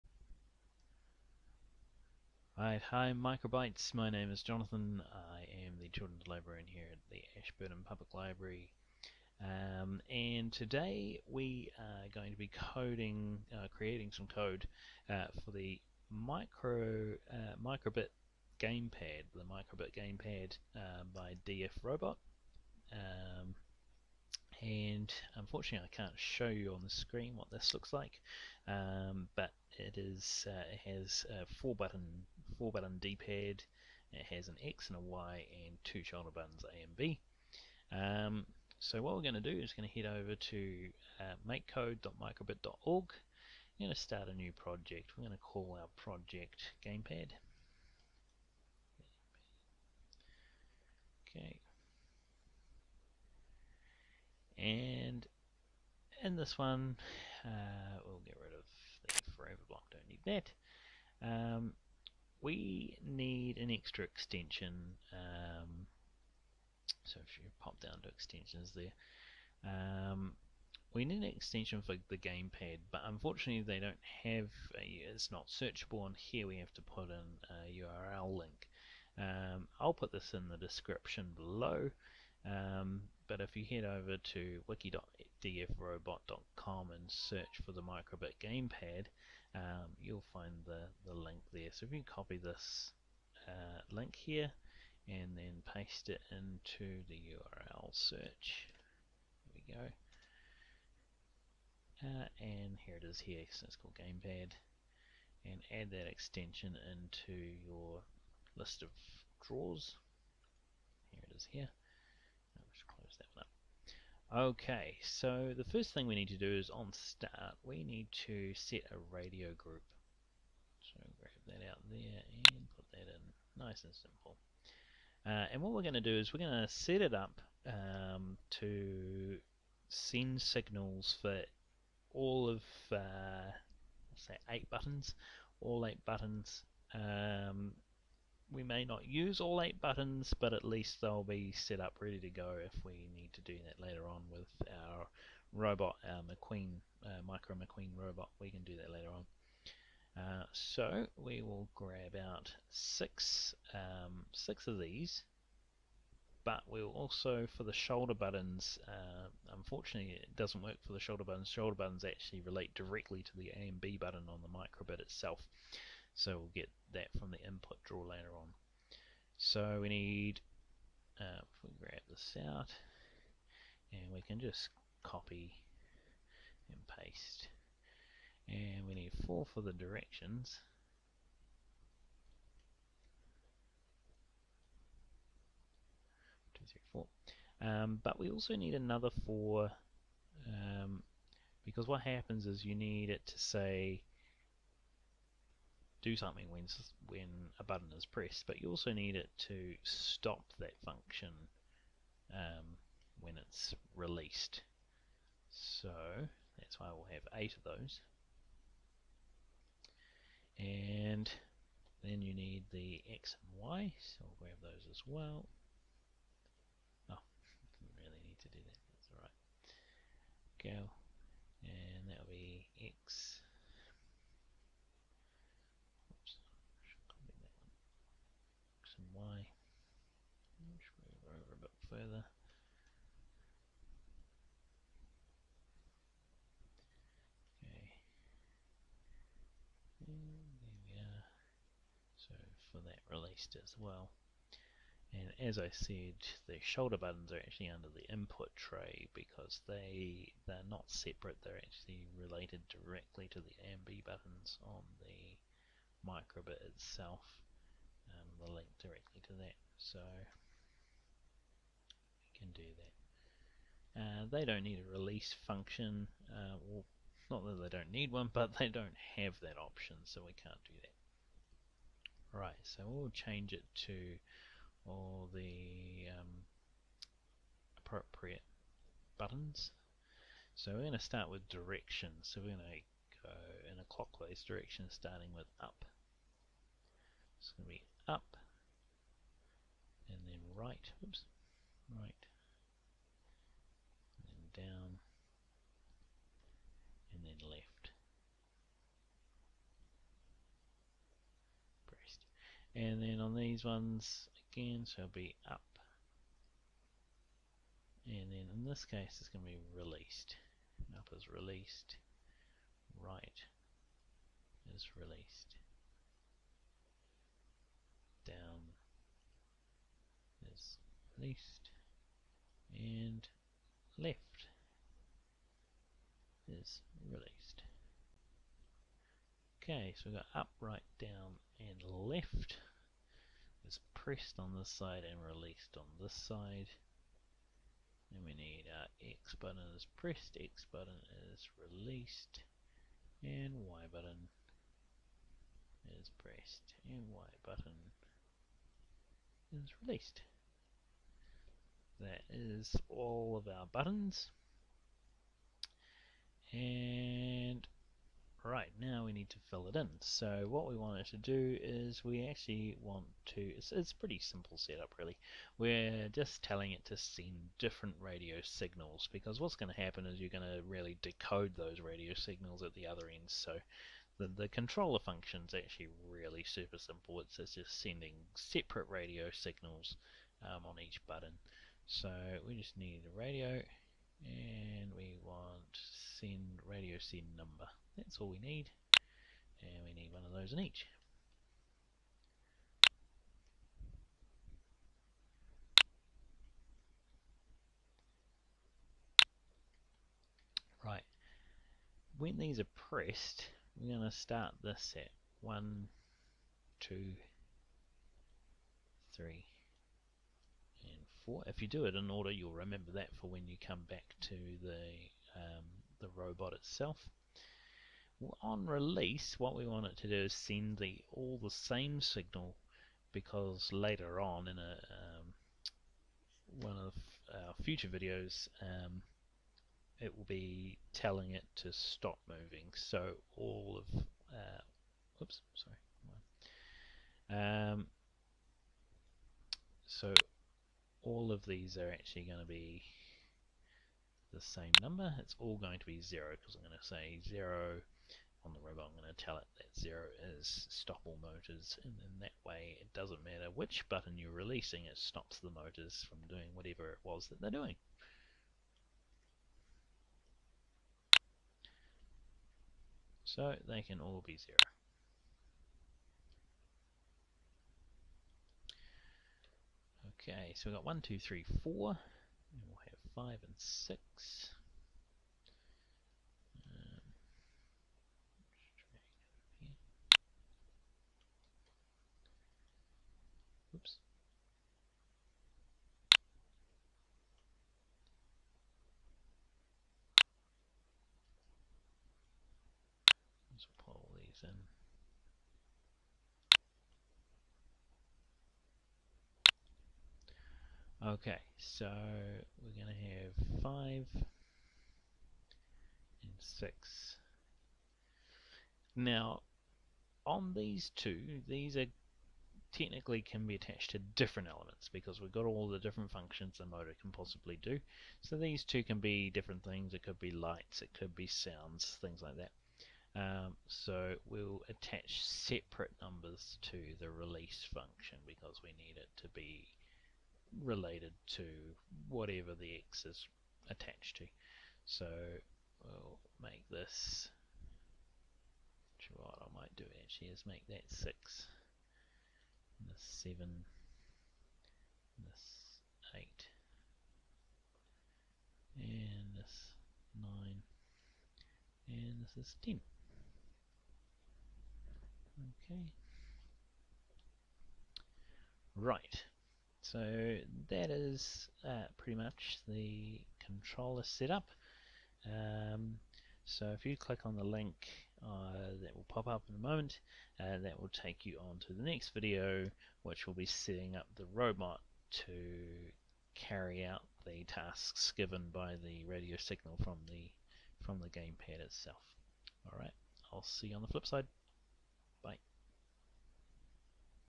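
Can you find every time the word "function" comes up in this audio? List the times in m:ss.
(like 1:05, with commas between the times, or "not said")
3:20, 4:25, 6:15, 8:36, 8:47.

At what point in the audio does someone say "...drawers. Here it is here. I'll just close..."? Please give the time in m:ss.
1:49.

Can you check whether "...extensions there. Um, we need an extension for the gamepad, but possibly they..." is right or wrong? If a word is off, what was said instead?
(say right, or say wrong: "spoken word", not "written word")
wrong: "unfortunately", not "possibly".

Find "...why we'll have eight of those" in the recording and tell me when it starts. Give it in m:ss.
3:26.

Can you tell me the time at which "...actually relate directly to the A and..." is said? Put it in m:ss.
2:42.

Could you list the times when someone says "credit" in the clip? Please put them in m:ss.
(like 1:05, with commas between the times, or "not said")
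not said.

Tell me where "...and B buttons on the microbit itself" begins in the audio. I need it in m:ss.
4:13.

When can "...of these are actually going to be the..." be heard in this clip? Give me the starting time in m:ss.
7:21.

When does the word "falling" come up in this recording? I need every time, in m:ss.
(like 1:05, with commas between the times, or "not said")
not said.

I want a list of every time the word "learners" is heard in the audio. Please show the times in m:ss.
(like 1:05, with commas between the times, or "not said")
not said.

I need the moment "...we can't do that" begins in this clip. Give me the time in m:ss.
4:30.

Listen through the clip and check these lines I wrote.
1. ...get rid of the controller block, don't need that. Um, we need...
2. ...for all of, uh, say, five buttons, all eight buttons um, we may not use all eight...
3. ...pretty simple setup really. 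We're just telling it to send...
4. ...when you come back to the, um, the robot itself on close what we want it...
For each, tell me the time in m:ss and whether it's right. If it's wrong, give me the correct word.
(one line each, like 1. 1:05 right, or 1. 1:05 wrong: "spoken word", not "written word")
1. 0:58 wrong: "forever", not "controller"
2. 2:11 wrong: "eight", not "five"
3. 6:03 right
4. 6:53 wrong: "release", not "close".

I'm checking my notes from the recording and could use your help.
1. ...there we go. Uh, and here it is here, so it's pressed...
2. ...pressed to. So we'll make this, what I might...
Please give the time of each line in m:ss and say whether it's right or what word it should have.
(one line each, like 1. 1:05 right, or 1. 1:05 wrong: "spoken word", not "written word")
1. 1:39 wrong: "called", not "pressed"
2. 8:53 wrong: "attached", not "pressed".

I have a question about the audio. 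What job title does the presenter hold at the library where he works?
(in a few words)
Children's Librarian.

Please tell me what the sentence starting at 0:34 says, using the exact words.
It has an X and a Y and two shoulder buttons A and B.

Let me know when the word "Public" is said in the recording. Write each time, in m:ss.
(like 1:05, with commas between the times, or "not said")
0:07.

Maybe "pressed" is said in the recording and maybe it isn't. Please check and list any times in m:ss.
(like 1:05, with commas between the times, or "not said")
3:18, 5:33, 5:39, 5:46, 6:42.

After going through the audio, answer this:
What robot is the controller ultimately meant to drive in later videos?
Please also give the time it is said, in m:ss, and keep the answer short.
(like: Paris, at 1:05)
Micro Maqueen, at 2:27.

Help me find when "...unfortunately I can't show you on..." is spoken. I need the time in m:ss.
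0:25.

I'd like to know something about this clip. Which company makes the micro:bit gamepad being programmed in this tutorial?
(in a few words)
DF Robot.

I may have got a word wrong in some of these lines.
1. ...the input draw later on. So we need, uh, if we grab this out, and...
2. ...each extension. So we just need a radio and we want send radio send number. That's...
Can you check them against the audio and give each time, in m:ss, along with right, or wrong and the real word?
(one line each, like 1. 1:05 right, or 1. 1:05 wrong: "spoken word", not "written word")
1. 2:47 right
2. 6:20 wrong: "button", not "extension".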